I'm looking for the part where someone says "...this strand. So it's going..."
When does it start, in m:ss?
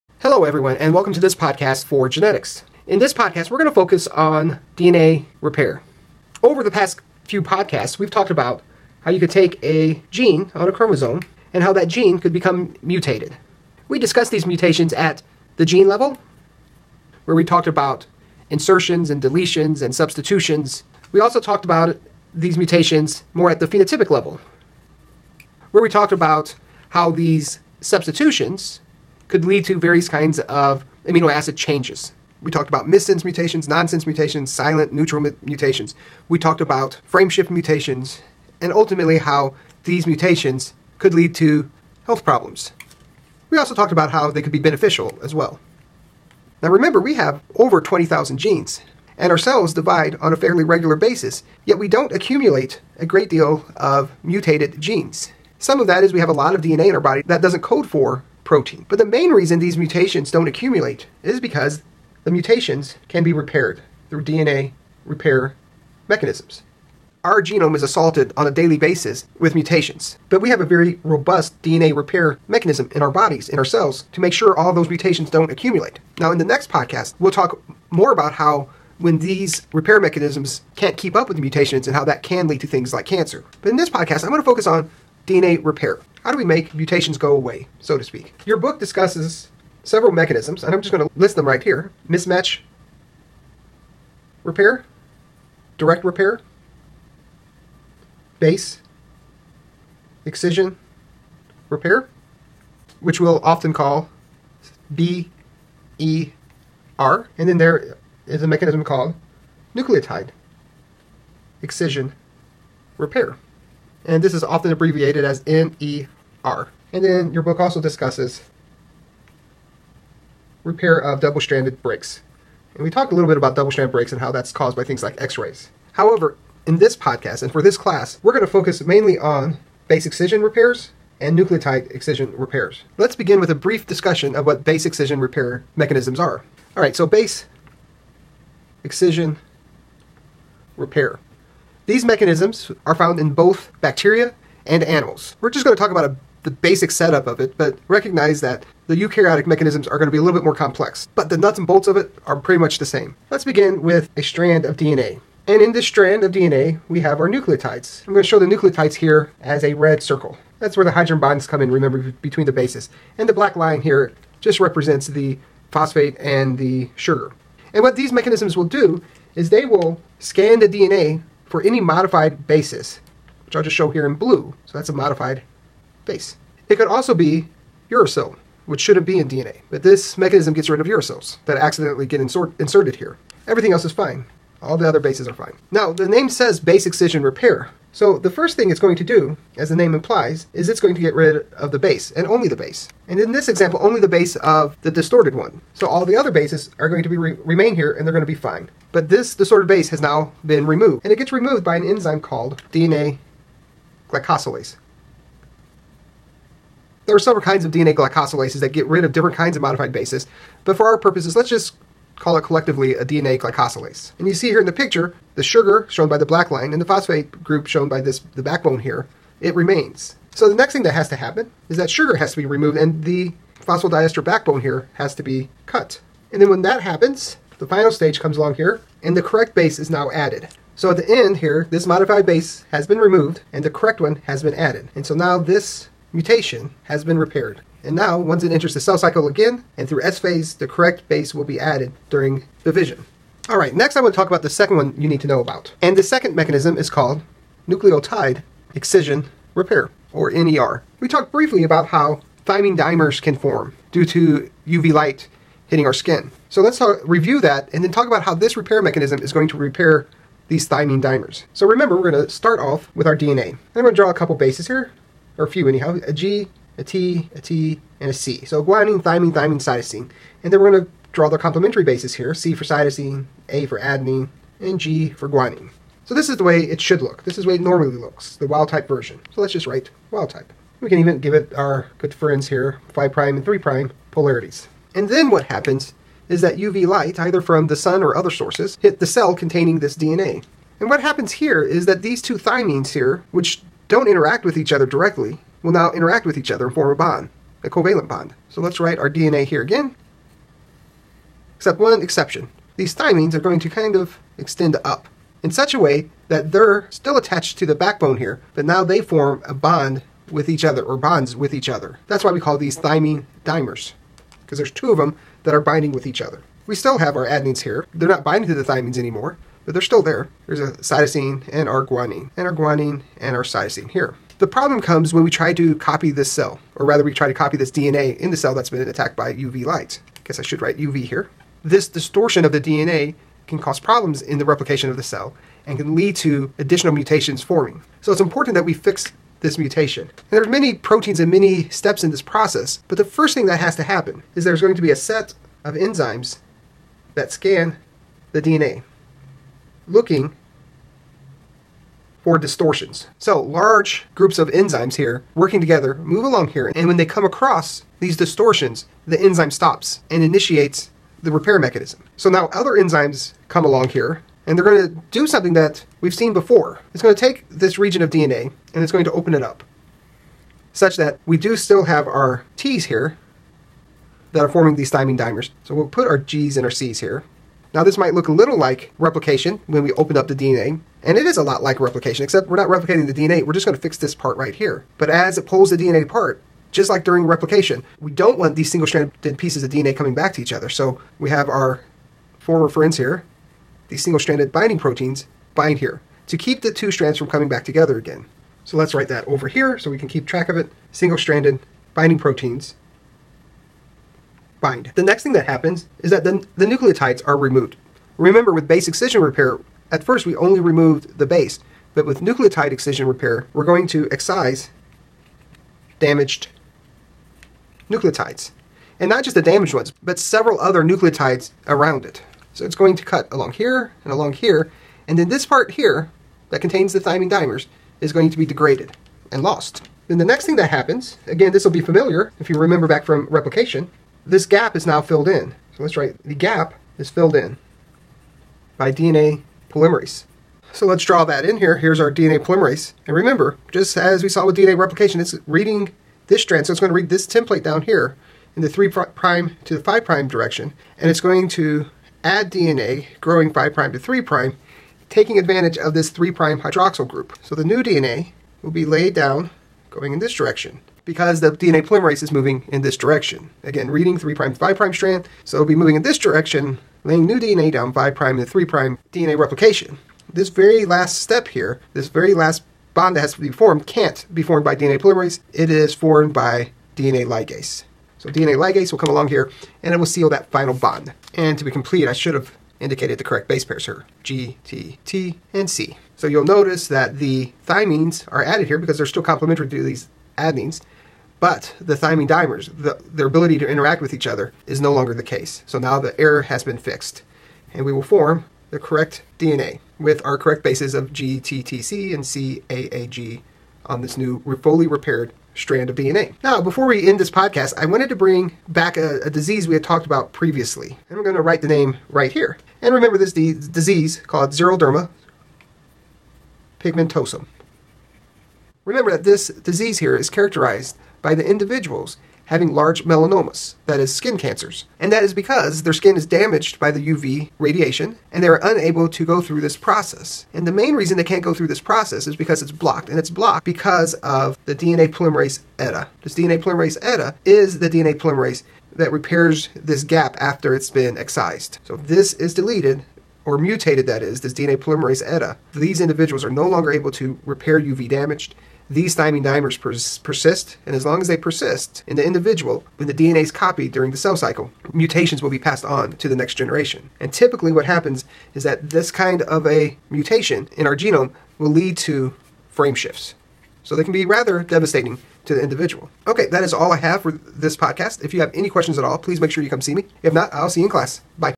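7:26.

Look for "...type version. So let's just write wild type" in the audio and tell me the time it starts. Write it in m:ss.
4:38.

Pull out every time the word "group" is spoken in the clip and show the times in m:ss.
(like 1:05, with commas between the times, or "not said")
3:37, 5:54, 7:37.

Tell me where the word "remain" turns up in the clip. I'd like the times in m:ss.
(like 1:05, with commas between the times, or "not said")
3:17, 3:39.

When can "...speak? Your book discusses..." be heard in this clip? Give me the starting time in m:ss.
1:28.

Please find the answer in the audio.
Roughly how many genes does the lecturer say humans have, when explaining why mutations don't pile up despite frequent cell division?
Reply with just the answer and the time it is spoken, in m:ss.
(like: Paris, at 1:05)
over 20,000, at 0:47.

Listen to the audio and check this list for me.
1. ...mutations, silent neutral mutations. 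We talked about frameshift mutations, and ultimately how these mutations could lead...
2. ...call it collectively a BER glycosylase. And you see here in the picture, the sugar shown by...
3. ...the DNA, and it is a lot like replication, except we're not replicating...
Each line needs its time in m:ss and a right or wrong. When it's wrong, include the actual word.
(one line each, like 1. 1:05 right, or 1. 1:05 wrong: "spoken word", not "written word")
1. 0:34 right
2. 3:32 wrong: "DNA", not "BER"
3. 6:20 right.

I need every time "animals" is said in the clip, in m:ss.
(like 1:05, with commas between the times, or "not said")
2:24.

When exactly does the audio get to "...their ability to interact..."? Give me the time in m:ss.
8:13.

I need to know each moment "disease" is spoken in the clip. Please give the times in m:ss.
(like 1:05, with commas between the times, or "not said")
8:29, 8:33, 8:39.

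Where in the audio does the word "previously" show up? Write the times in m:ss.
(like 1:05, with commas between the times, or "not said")
8:30.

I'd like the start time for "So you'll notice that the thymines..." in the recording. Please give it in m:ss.
8:06.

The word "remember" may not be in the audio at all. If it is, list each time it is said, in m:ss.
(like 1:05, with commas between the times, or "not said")
0:46, 2:41, 4:21, 6:48, 7:12, 7:23, 8:32, 8:38.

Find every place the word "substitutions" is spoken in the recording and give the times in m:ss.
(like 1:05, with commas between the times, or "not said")
0:19, 0:27.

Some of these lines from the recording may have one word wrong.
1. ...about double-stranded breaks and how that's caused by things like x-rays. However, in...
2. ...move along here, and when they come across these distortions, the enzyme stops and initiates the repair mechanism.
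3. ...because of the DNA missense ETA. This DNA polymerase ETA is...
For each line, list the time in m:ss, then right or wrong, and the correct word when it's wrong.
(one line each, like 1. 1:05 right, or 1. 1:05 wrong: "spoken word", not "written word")
1. 2:03 right
2. 5:55 right
3. 8:53 wrong: "polymerase", not "missense".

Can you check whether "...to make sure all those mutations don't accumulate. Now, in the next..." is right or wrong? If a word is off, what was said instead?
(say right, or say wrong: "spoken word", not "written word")
right.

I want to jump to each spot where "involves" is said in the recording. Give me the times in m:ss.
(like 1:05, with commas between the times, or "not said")
not said.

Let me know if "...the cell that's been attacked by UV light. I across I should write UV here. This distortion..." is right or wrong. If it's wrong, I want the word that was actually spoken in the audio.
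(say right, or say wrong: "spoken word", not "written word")
wrong: "guess", not "across".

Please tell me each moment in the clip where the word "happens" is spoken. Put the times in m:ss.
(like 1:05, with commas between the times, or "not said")
3:41, 3:46, 4:45, 4:51, 5:43, 6:45, 7:10, 9:17.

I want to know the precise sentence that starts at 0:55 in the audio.
Some of that is we have a lot of DNA in our body that doesn't code for protein.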